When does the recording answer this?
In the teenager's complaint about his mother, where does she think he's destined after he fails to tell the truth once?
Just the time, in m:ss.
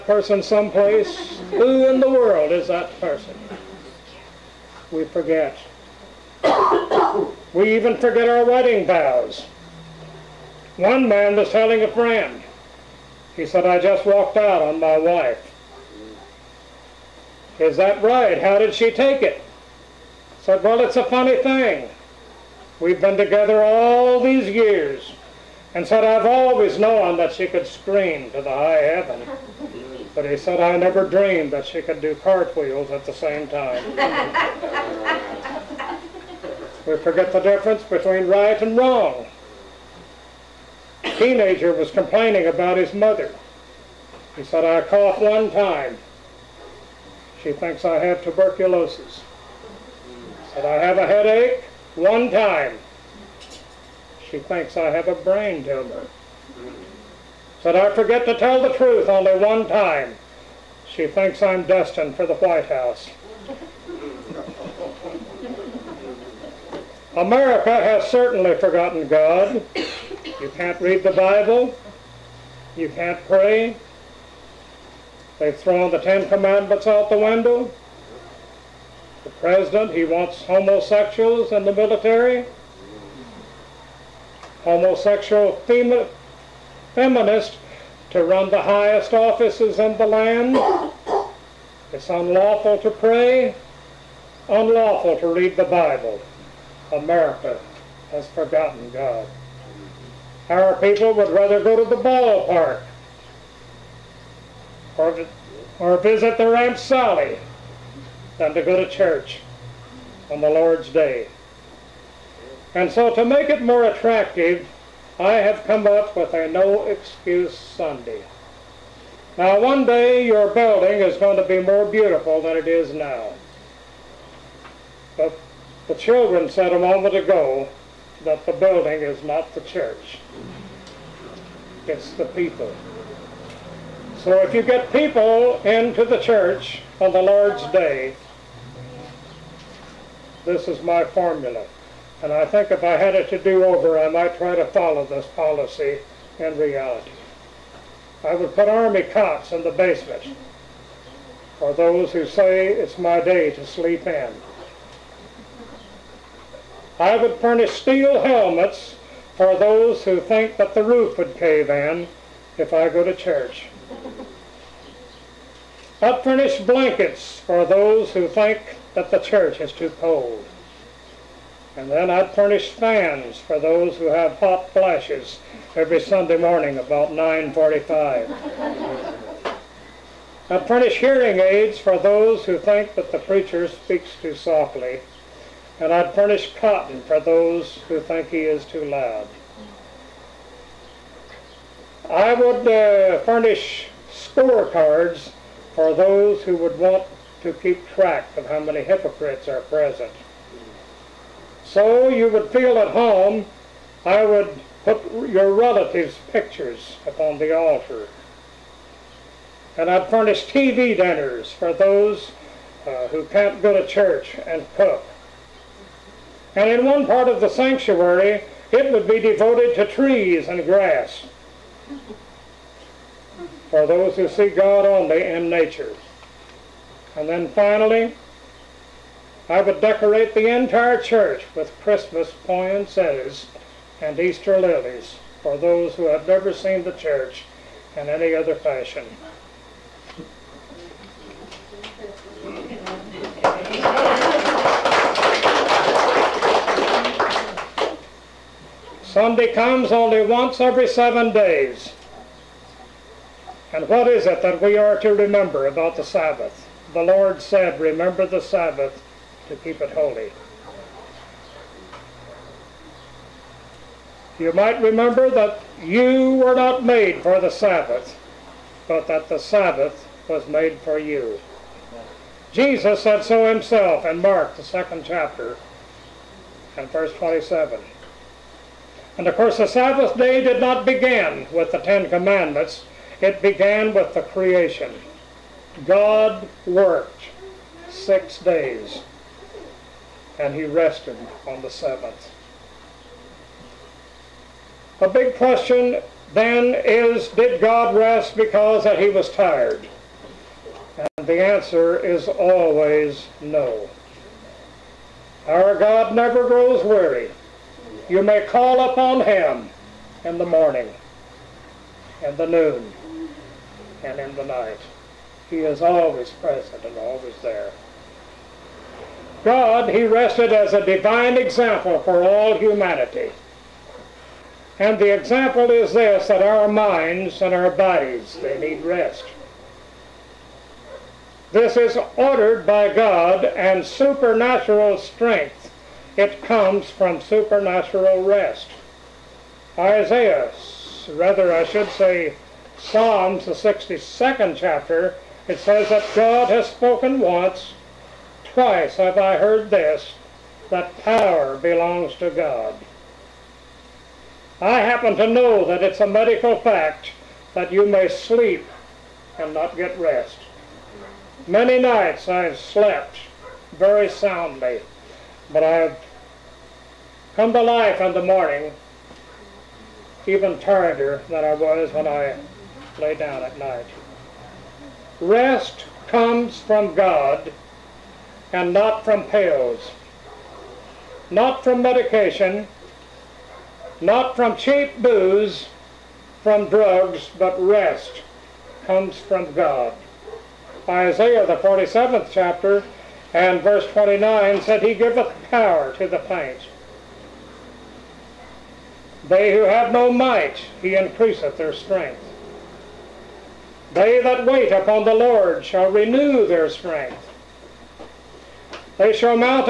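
1:02.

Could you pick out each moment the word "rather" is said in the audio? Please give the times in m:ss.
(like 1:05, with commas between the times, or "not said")
1:41, 5:41.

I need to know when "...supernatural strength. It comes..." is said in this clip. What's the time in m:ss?
5:33.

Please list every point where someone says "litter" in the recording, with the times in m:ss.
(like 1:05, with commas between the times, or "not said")
not said.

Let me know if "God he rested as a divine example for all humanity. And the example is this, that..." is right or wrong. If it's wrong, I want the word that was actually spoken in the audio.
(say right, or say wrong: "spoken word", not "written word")
right.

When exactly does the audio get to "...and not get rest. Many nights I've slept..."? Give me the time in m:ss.
5:59.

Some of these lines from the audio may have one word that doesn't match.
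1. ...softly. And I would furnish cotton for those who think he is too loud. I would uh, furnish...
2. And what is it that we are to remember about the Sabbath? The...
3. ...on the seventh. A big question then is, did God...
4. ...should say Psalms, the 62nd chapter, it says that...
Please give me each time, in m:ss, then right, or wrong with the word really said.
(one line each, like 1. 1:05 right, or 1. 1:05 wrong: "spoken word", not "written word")
1. 3:04 right
2. 4:13 right
3. 4:51 right
4. 5:41 right.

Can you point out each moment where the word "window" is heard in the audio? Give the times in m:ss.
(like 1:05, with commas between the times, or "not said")
1:17.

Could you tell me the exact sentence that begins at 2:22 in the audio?
And I think if I had it to do over, I might try to follow this policy in reality.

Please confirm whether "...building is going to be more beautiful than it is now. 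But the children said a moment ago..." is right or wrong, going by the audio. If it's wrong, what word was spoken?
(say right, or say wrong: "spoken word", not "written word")
right.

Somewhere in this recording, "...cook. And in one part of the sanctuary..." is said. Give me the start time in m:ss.
3:34.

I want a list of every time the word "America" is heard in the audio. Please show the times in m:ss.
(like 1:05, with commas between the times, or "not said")
1:07, 1:36.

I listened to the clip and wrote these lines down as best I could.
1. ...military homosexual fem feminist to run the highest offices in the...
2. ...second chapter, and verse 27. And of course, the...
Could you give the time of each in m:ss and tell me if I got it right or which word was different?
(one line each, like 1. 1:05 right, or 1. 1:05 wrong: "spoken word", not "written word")
1. 1:21 right
2. 4:34 right.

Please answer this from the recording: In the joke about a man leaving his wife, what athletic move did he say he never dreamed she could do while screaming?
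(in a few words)
cartwheels.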